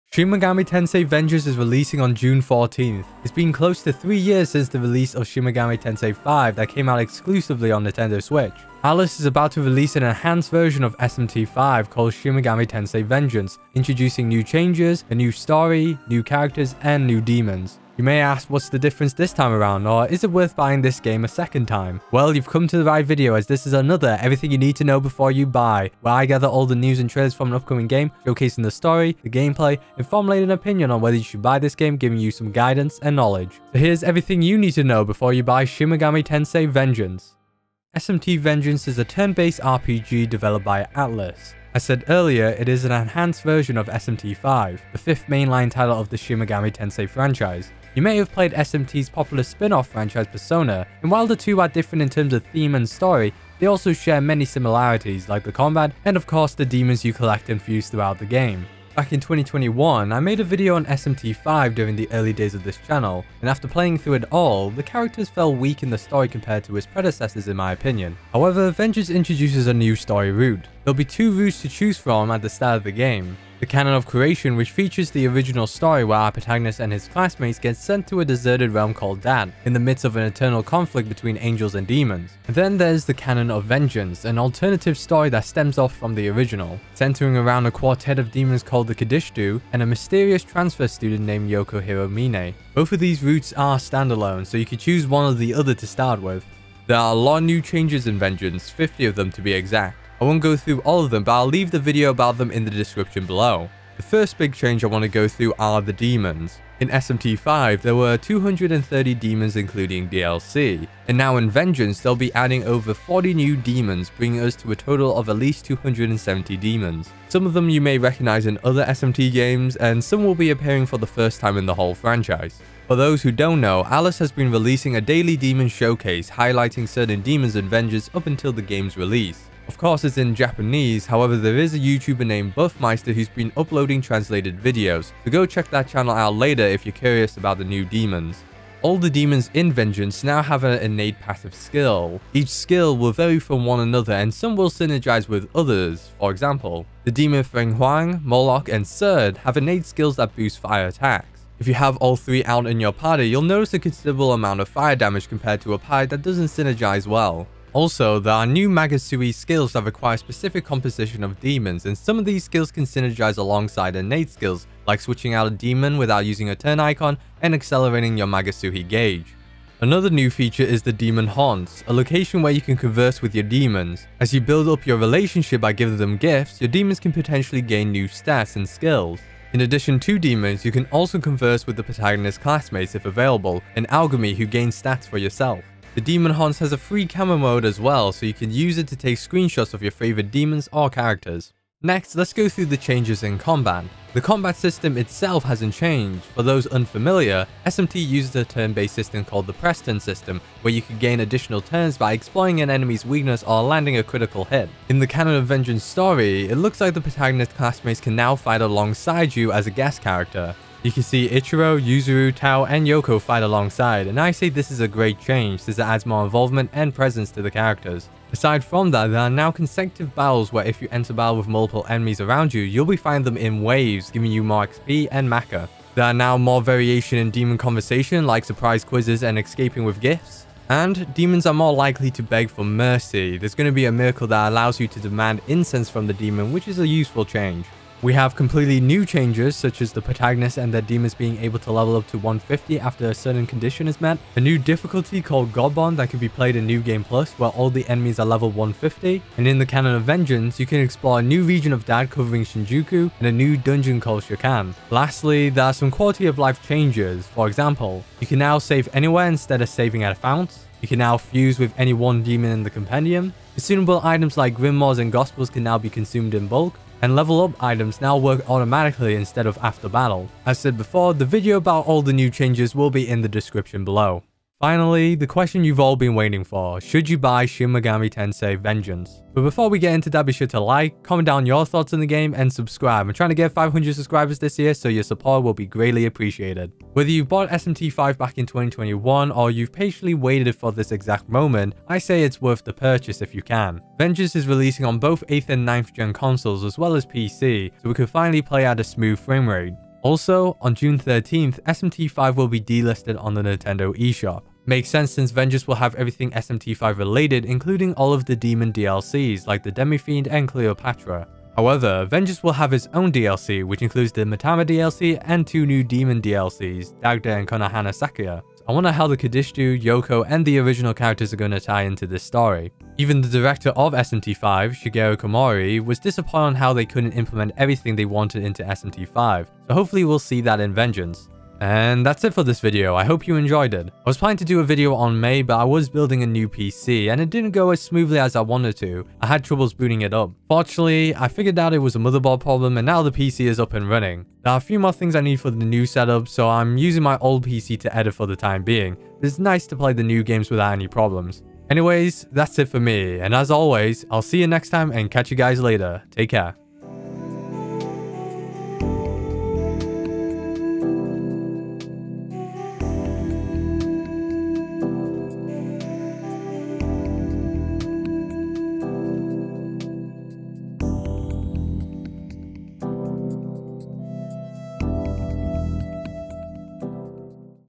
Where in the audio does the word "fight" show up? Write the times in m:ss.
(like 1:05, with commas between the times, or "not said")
3:28, 3:33.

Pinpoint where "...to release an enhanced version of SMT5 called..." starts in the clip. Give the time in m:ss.
0:09.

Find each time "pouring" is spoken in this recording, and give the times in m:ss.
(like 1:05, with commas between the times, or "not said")
not said.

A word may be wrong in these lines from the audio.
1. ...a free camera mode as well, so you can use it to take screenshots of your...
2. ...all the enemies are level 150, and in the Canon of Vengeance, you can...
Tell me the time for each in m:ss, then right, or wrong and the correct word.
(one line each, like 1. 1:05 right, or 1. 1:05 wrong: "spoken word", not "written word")
1. 3:06 right
2. 4:07 right.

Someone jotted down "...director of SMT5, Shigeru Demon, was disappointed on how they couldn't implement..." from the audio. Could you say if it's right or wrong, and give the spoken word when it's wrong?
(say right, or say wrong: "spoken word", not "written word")
wrong: "Komori", not "Demon".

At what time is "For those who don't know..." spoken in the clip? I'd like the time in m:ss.
2:02.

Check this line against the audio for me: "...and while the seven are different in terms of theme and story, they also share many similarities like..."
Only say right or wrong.
wrong.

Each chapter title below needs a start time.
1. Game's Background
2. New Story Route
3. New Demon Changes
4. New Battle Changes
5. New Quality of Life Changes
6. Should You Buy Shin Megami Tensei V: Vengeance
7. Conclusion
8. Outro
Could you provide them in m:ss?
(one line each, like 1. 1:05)
1. 0:38
2. 1:09
3. 1:36
4. 3:11
5. 3:57
6. 4:34
7. 5:31
8. 5:57.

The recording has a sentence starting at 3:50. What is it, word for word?
And demons are more likely to beg for mercy.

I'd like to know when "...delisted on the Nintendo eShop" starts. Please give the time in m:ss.
5:02.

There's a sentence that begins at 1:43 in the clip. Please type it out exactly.
The first big change I want to go through are the demons.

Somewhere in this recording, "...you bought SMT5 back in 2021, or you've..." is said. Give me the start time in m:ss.
4:47.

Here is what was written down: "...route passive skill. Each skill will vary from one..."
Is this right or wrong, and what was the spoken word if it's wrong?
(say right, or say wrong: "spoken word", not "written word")
wrong: "innate", not "route".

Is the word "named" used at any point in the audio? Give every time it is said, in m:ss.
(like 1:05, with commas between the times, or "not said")
1:31, 2:12.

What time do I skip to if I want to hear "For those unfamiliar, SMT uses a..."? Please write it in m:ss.
3:16.